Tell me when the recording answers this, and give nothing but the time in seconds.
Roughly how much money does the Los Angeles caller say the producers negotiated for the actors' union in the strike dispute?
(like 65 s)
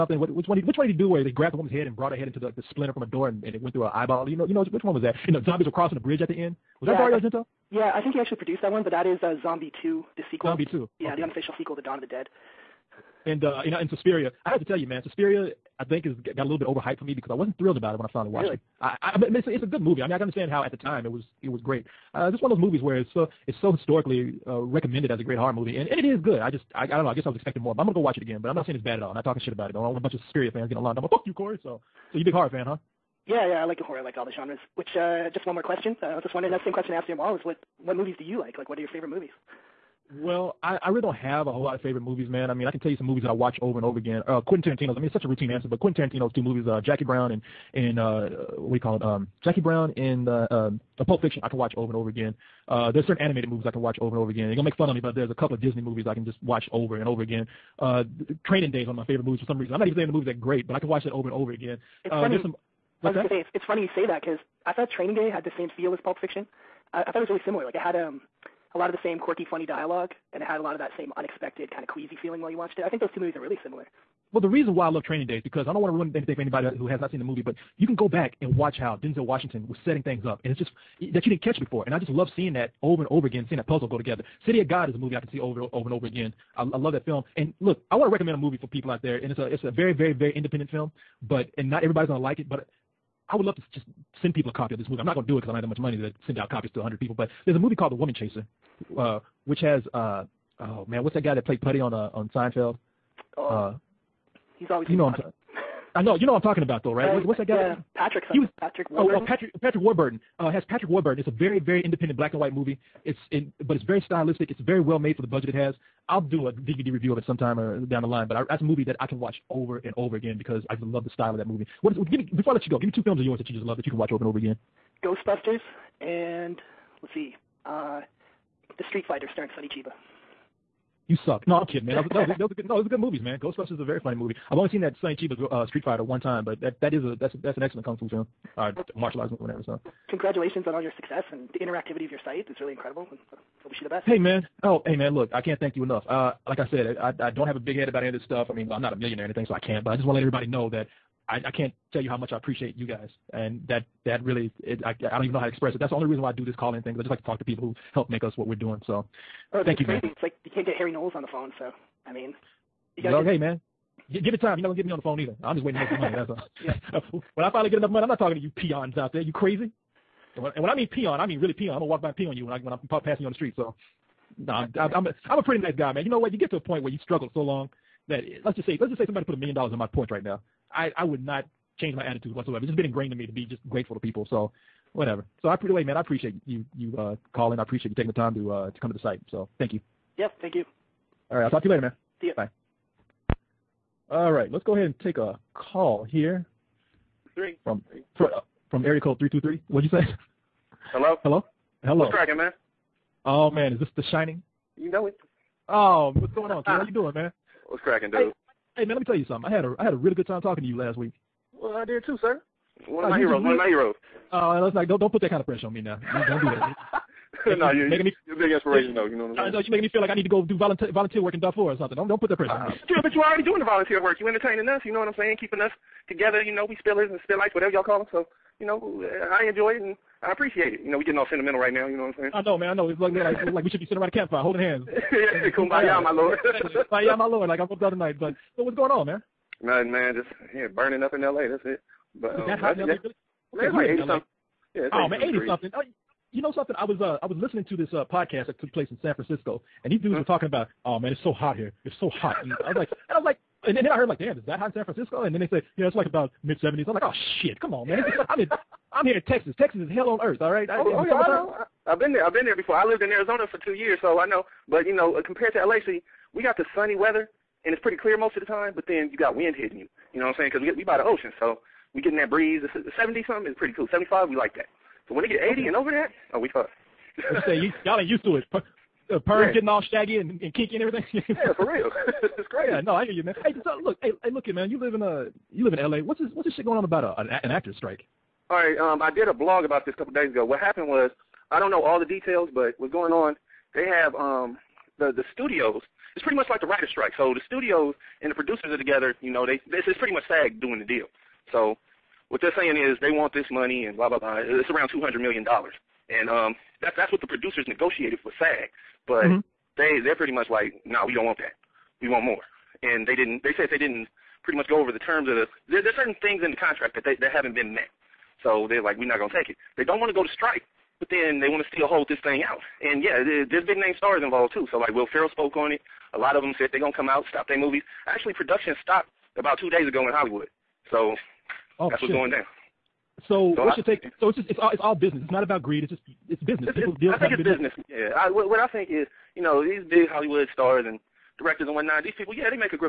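304 s.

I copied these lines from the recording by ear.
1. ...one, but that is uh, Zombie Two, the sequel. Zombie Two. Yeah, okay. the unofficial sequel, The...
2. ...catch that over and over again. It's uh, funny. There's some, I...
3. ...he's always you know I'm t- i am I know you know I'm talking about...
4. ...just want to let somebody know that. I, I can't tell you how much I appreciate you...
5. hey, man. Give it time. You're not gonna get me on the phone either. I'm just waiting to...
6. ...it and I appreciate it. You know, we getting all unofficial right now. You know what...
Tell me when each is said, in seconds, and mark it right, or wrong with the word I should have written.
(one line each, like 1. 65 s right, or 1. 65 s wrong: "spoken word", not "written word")
1. 8 s right
2. 60 s wrong: "watch", not "catch"
3. 104 s right
4. 149 s wrong: "everybody", not "somebody"
5. 163 s right
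6. 229 s wrong: "sentimental", not "unofficial".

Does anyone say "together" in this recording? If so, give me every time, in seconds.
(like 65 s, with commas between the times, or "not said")
83 s, 226 s, 298 s.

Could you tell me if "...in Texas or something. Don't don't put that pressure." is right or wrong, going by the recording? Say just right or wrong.
wrong.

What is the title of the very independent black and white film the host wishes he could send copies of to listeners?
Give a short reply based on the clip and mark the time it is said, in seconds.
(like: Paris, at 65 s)
The Woman Chaser, at 97 s.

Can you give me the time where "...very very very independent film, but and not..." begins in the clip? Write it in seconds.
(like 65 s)
89 s.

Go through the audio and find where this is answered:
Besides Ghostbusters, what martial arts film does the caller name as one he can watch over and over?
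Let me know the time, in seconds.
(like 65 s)
128 s.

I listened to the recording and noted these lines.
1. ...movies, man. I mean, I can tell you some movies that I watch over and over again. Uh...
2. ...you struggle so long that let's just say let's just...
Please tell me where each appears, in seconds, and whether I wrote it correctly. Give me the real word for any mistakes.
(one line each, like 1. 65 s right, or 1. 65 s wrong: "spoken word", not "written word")
1. 41 s right
2. 176 s right.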